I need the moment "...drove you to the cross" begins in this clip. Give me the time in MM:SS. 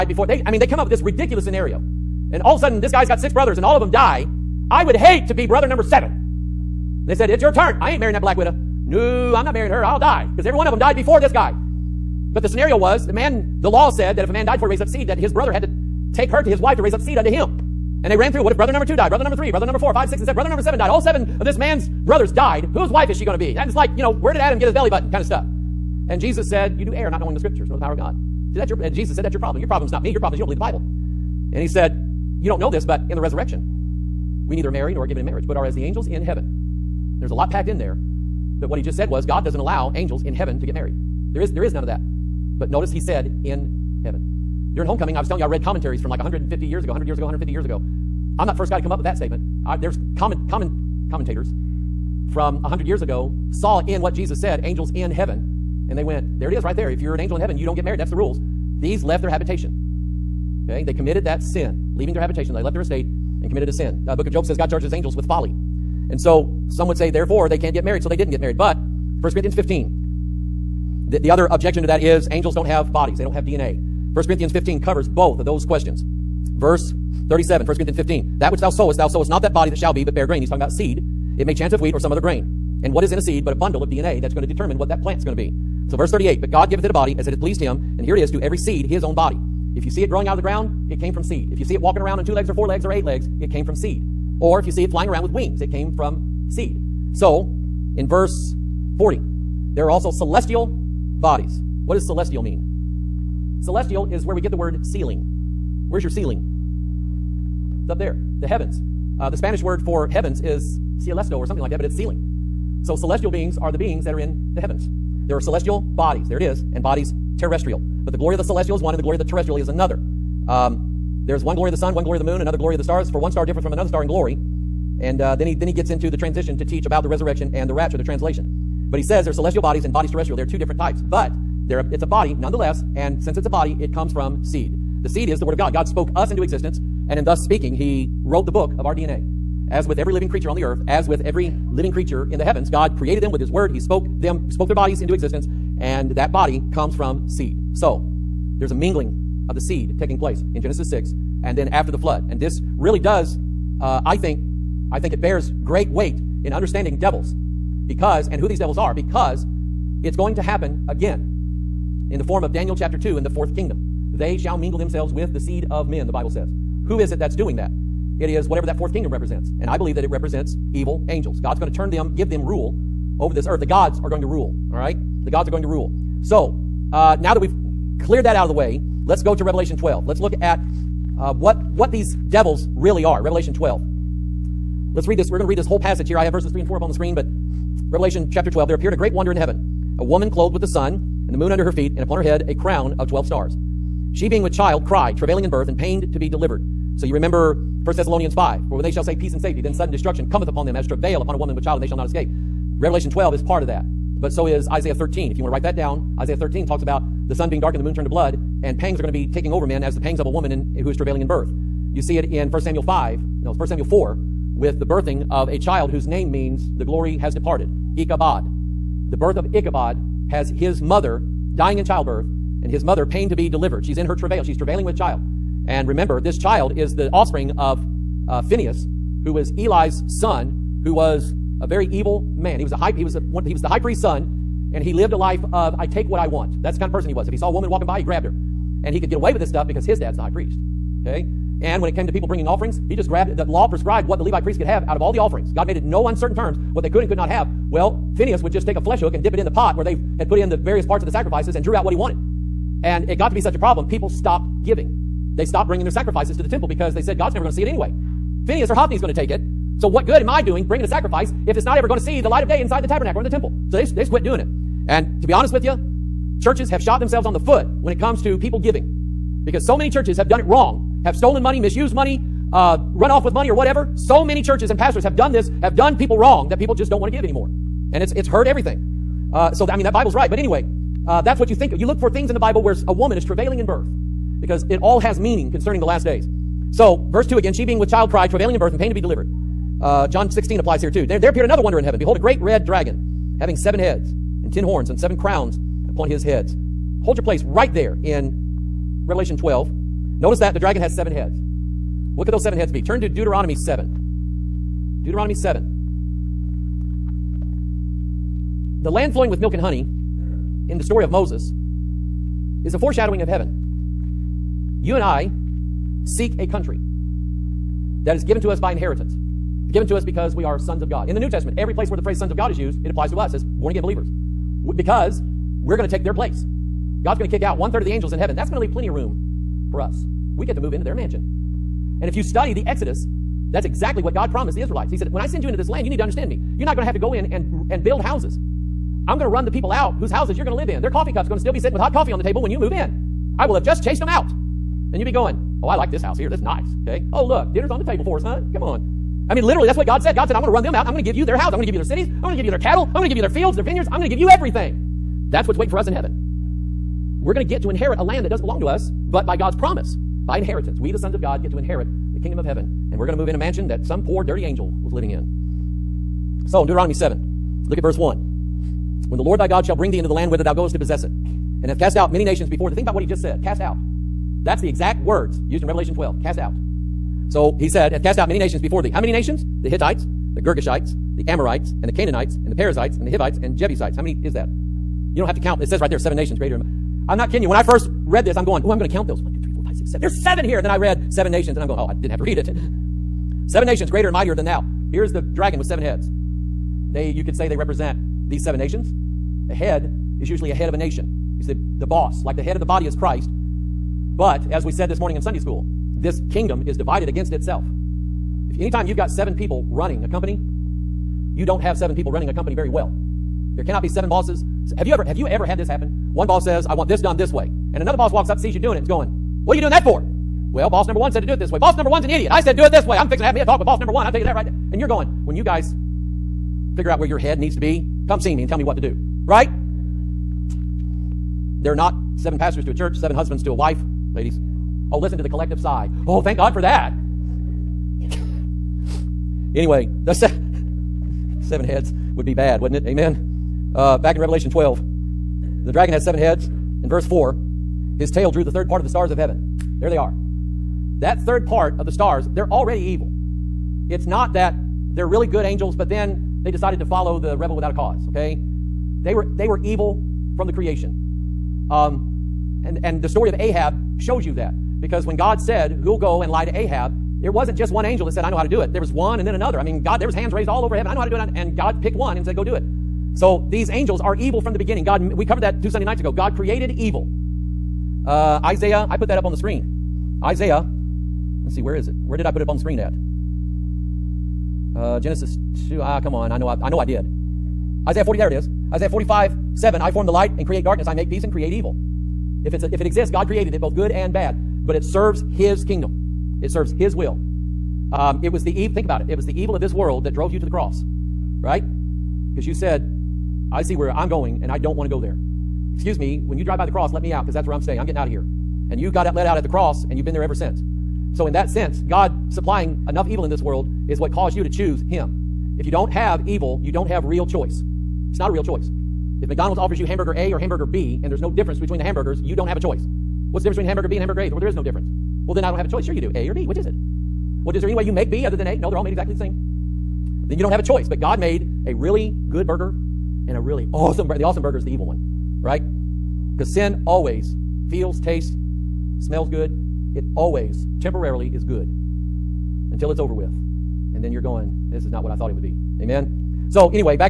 08:20.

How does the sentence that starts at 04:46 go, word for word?
So, verse 2 again, she being with child cried, travailing in birth and pain to be delivered.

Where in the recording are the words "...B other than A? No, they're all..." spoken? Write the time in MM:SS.
08:48.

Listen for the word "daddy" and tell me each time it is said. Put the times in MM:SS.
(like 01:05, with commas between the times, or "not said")
not said.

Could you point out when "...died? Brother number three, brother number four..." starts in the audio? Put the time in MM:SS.
00:18.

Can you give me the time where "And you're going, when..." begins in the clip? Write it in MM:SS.
07:04.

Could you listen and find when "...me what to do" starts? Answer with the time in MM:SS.
07:08.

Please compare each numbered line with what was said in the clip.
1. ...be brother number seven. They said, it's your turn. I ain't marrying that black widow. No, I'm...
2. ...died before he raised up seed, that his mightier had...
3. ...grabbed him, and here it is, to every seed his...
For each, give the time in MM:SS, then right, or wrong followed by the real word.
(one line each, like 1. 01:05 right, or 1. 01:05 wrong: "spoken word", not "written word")
1. 00:05 right
2. 00:14 wrong: "brother", not "mightier"
3. 01:27 wrong: "pleased", not "grabbed".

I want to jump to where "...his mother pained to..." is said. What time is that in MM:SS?
03:42.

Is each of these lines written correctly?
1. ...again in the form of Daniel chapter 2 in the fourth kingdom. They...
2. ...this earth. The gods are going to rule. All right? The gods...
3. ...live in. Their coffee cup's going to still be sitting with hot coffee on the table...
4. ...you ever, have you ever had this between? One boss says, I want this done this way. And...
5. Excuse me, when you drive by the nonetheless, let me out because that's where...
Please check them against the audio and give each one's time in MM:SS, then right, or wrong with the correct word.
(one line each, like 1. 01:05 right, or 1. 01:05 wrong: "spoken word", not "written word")
1. 02:40 right
2. 02:53 right
3. 05:40 right
4. 06:54 wrong: "happen", not "between"
5. 08:25 wrong: "cross", not "nonetheless".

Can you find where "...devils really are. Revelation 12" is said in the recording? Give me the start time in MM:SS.
03:02.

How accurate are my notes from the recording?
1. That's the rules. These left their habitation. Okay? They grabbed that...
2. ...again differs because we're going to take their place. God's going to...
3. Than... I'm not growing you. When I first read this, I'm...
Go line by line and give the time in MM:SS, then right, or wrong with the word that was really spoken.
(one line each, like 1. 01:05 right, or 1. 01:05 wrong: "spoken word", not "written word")
1. 00:57 wrong: "committed", not "grabbed"
2. 05:23 wrong: "believers", not "differs"
3. 06:26 wrong: "kidding", not "growing".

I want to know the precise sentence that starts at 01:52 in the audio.
So celestial beings are the beings that are in the heavens.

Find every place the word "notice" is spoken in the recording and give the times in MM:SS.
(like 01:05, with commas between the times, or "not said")
00:42, 05:00.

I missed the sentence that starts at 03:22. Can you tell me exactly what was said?
Revelation 12 is part of that.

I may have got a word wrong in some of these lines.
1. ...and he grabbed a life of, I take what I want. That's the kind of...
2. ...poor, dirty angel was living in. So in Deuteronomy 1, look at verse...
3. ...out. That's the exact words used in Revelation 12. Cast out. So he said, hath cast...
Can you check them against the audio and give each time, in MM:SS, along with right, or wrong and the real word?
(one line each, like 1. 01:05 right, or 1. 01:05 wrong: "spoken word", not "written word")
1. 03:54 wrong: "lived", not "grabbed"
2. 06:04 wrong: "7", not "1"
3. 06:13 right.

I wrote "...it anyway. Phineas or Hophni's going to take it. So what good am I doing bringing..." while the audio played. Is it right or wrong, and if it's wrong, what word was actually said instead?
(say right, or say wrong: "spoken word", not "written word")
right.